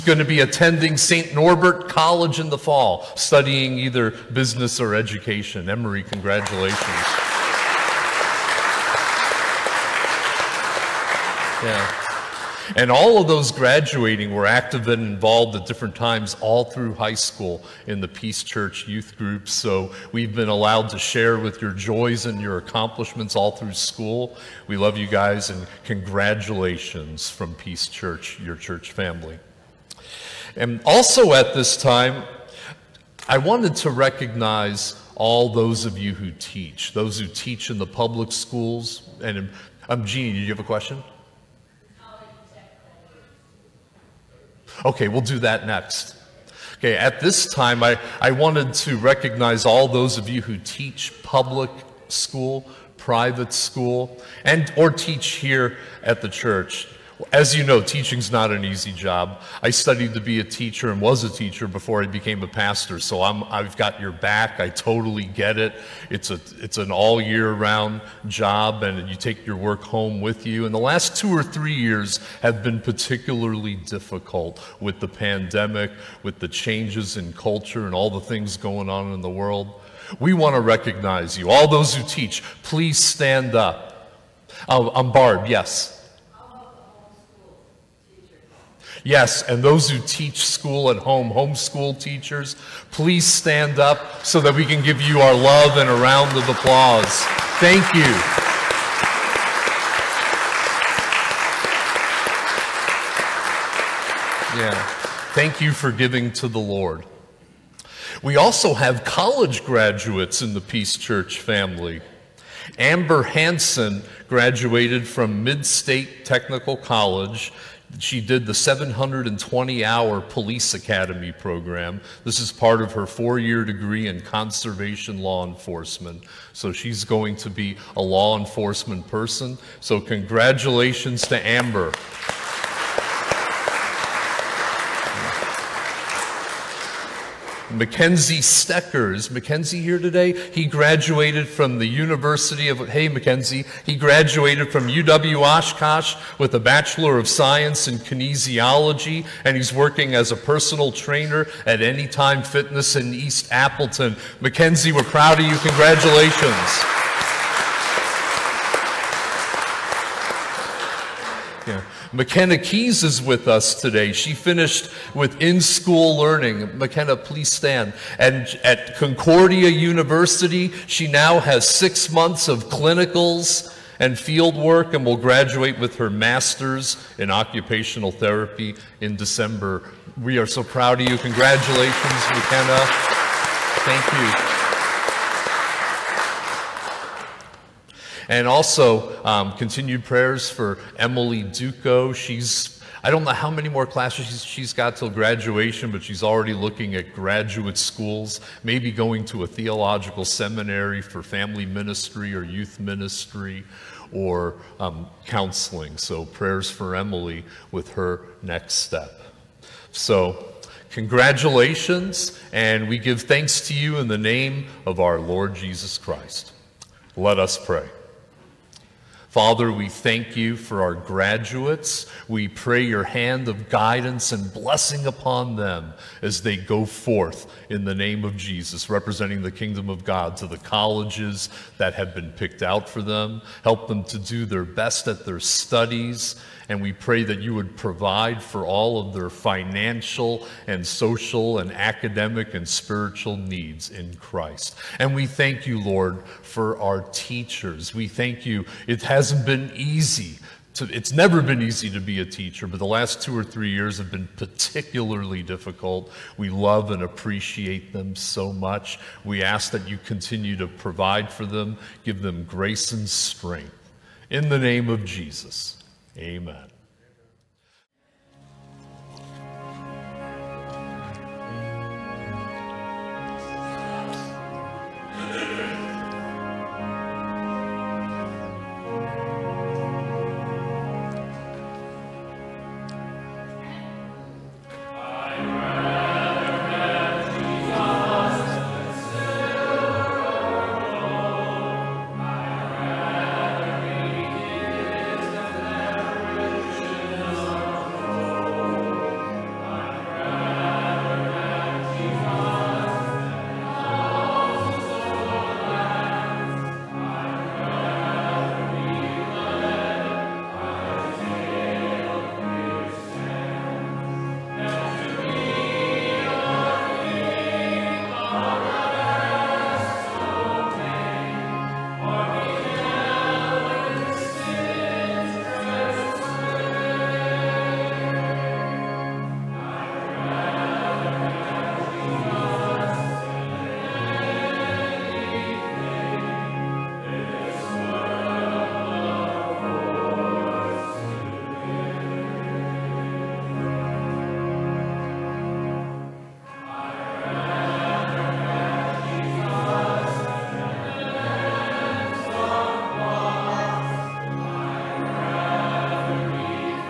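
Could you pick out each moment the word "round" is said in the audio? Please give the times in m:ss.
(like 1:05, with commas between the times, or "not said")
1:07, 1:35.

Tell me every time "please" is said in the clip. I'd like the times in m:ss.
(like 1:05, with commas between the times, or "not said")
1:22, 1:32, 2:47.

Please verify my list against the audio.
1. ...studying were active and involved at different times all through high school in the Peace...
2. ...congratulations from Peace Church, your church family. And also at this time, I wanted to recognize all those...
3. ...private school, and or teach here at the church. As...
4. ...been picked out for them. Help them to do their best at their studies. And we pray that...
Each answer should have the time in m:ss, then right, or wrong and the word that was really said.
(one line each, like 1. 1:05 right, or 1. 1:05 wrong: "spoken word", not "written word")
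1. 0:13 wrong: "graduating", not "studying"
2. 0:25 right
3. 0:52 right
4. 3:52 right.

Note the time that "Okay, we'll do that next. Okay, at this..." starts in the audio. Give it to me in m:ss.
0:44.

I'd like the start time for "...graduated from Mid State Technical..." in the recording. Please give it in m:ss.
1:54.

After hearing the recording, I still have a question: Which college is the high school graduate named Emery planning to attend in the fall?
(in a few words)
St. Norbert College.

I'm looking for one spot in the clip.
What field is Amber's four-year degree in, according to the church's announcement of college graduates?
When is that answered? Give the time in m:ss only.
2:04.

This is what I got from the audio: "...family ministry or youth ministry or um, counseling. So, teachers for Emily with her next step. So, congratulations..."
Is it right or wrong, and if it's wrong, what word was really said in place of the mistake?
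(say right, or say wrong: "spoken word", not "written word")
wrong: "prayers", not "teachers".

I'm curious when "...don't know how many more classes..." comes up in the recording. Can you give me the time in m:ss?
3:13.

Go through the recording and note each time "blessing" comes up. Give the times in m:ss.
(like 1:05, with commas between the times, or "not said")
3:44.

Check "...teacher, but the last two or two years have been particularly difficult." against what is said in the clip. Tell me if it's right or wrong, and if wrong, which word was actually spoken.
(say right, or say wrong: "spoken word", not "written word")
wrong: "three", not "two".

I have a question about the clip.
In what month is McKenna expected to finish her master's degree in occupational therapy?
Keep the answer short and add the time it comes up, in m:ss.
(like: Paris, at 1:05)
December, at 2:59.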